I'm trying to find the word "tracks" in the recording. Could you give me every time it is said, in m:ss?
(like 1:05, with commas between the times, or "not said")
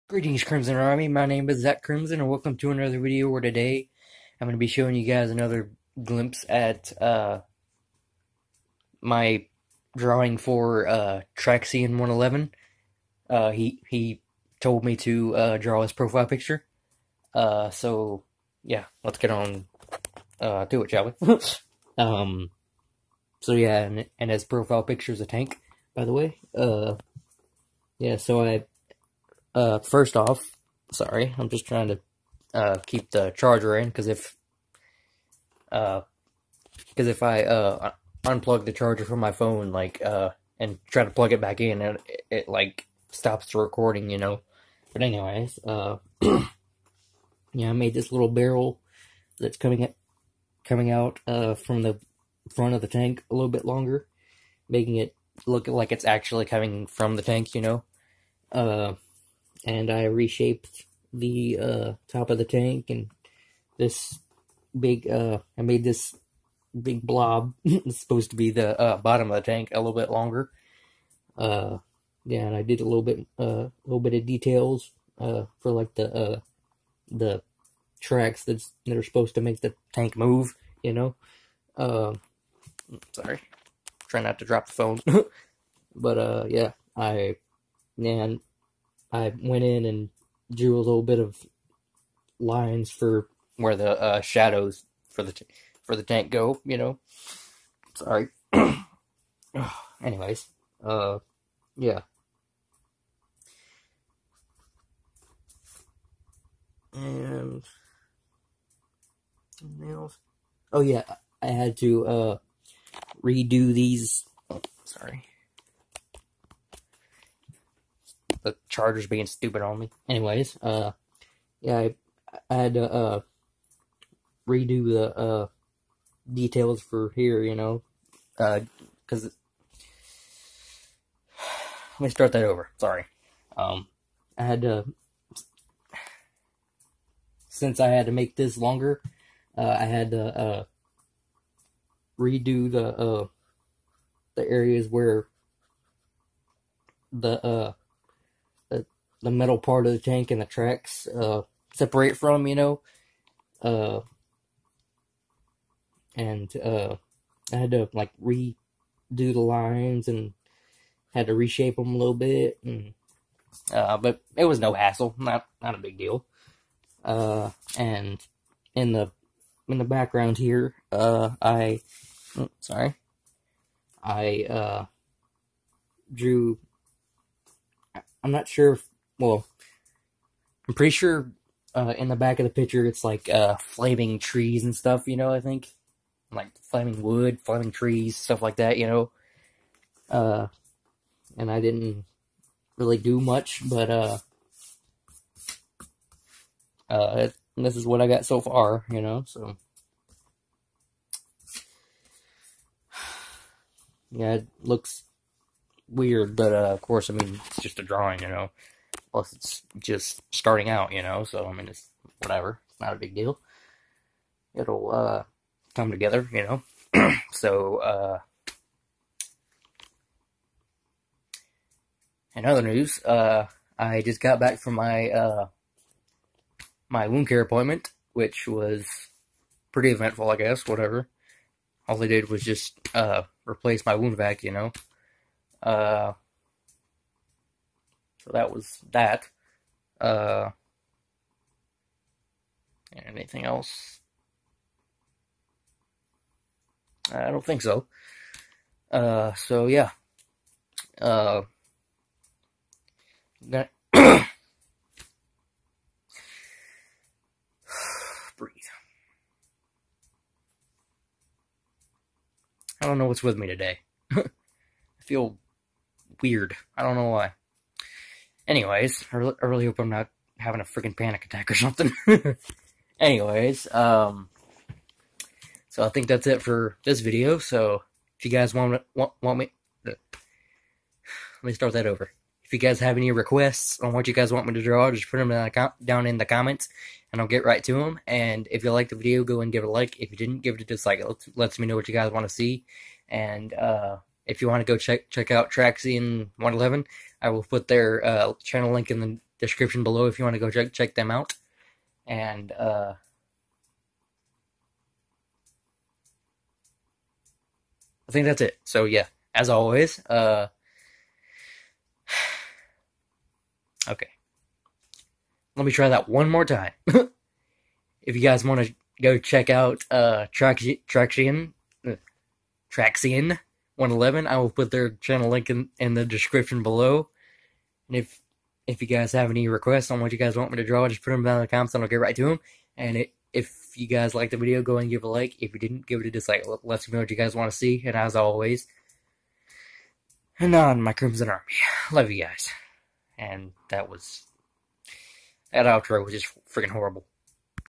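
1:17, 2:30.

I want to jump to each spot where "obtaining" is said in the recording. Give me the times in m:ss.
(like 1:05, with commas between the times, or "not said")
not said.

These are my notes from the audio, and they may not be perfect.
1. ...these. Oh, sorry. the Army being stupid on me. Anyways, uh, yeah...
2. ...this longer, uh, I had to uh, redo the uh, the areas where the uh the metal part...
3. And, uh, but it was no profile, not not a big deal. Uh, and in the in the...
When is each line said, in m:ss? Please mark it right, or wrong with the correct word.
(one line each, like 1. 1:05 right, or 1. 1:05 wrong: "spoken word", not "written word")
1. 1:53 wrong: "Chargers", not "Army"
2. 2:18 right
3. 2:42 wrong: "hassle", not "profile".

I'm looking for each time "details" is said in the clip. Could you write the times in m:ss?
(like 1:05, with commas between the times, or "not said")
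1:14, 2:06.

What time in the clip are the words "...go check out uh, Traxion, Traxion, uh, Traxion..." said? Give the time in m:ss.
5:19.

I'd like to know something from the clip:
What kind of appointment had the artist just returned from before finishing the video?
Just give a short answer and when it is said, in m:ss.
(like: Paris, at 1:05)
Wound care appointment, at 3:47.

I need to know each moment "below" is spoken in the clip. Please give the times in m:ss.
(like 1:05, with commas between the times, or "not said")
4:59, 5:26.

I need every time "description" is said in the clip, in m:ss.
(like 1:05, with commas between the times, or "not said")
4:59, 5:26.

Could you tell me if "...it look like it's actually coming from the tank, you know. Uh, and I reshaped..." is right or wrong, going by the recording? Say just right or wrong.
right.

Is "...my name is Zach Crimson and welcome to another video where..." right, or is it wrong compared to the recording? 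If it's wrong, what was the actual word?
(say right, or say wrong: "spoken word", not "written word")
right.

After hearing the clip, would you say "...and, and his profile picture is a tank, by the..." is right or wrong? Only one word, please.
right.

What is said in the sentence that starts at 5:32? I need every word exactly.
And it, if you guys liked the video, go and give a like.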